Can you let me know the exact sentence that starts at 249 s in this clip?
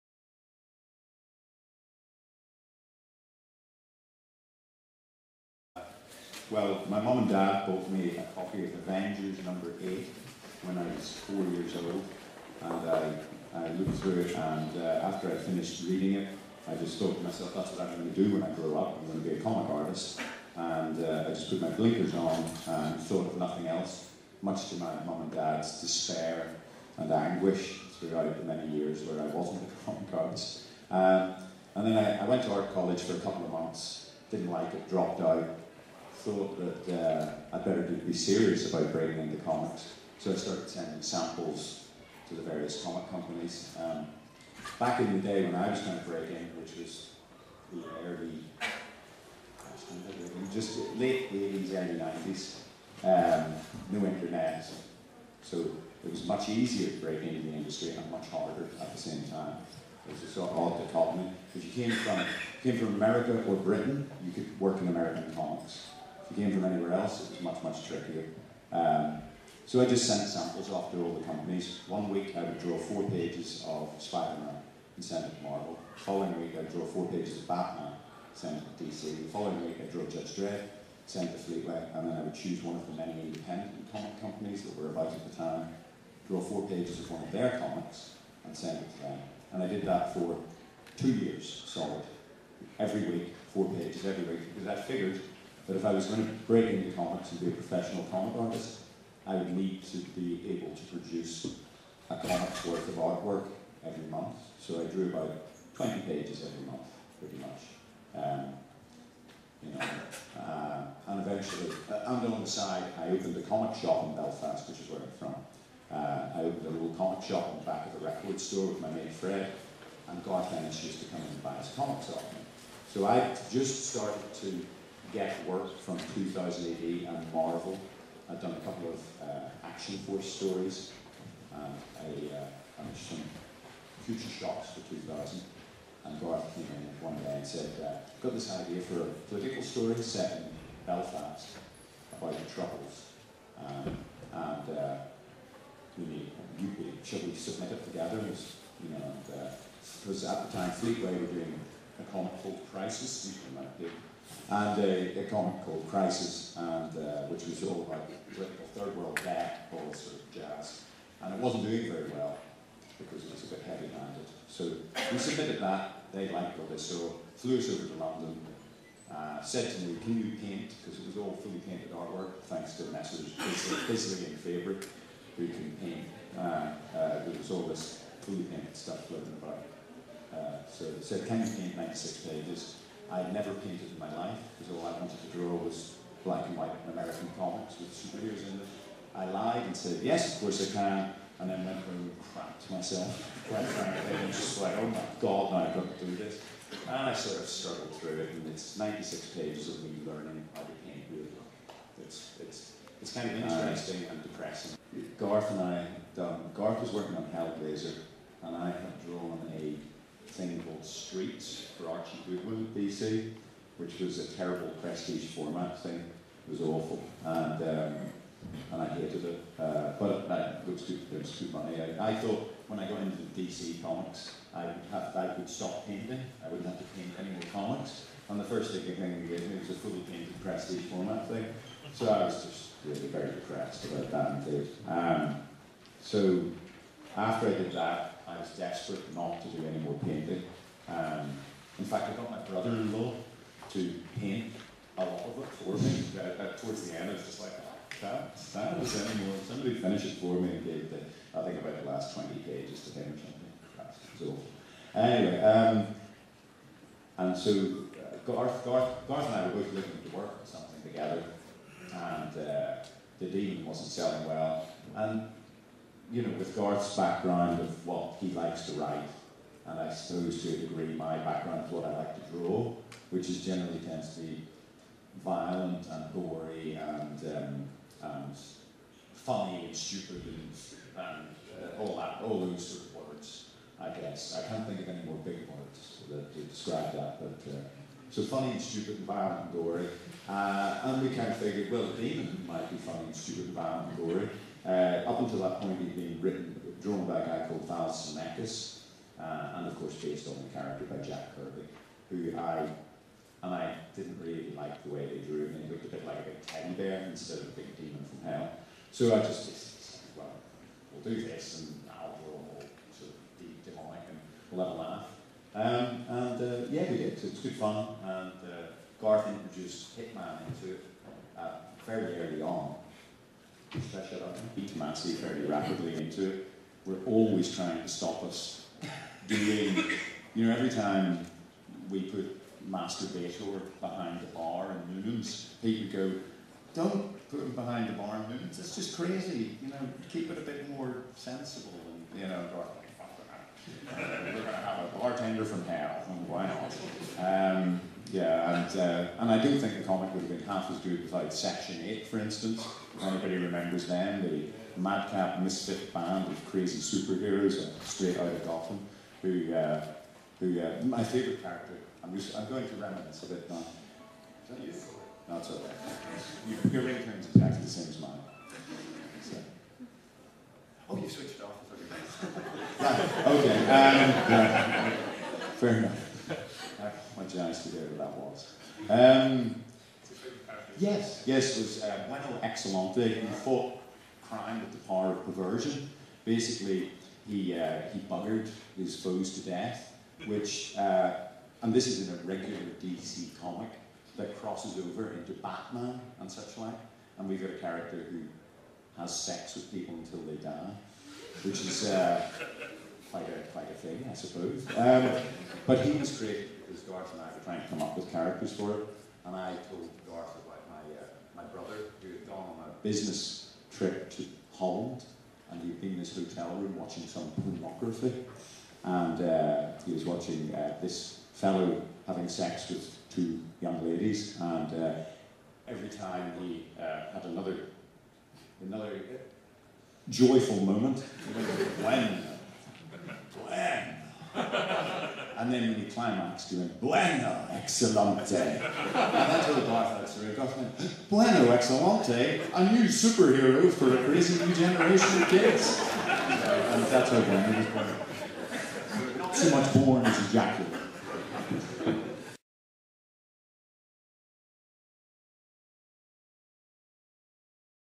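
Somebody finish it for me and gave the, I think about the last 20 pages to him or something.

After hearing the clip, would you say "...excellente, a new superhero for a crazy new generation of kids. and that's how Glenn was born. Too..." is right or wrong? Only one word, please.
right.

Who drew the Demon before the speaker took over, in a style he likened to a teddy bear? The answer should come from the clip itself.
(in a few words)
Val Semeiks.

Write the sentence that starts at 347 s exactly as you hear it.
Um, yeah, and uh, and I do think the comic would have been half as good without Section Eight, for instance.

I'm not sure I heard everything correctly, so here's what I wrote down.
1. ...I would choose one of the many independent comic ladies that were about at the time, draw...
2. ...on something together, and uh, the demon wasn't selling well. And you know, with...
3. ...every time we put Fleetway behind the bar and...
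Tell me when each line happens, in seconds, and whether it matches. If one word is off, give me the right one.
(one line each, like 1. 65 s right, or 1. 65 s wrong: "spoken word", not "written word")
1. 82 s wrong: "companies", not "ladies"
2. 260 s right
3. 330 s wrong: "Master", not "Fleetway".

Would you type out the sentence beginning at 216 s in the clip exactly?
It was awful, and um, and I hated it.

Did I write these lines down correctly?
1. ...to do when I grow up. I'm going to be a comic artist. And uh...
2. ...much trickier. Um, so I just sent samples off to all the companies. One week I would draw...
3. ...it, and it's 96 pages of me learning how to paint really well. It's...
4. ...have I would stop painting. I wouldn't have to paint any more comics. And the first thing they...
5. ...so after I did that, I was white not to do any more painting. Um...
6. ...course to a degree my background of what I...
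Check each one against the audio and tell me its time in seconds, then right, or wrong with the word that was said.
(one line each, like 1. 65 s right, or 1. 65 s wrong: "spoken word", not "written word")
1. 18 s right
2. 67 s right
3. 198 s right
4. 224 s right
5. 236 s wrong: "desperate", not "white"
6. 269 s wrong: "suppose", not "course".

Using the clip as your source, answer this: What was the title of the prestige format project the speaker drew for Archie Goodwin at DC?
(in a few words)
Streets.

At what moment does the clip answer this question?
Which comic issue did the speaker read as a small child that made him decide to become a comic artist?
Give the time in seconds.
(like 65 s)
8 s.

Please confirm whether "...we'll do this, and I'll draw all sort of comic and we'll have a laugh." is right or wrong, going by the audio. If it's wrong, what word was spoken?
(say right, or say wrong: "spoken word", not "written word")
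wrong: "demonic", not "comic".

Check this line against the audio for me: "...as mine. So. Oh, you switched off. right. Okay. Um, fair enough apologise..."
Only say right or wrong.
right.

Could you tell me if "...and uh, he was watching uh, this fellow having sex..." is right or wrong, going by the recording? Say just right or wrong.
right.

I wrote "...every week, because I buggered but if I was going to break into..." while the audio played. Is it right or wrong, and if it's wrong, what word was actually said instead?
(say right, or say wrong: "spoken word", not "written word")
wrong: "figured", not "buggered".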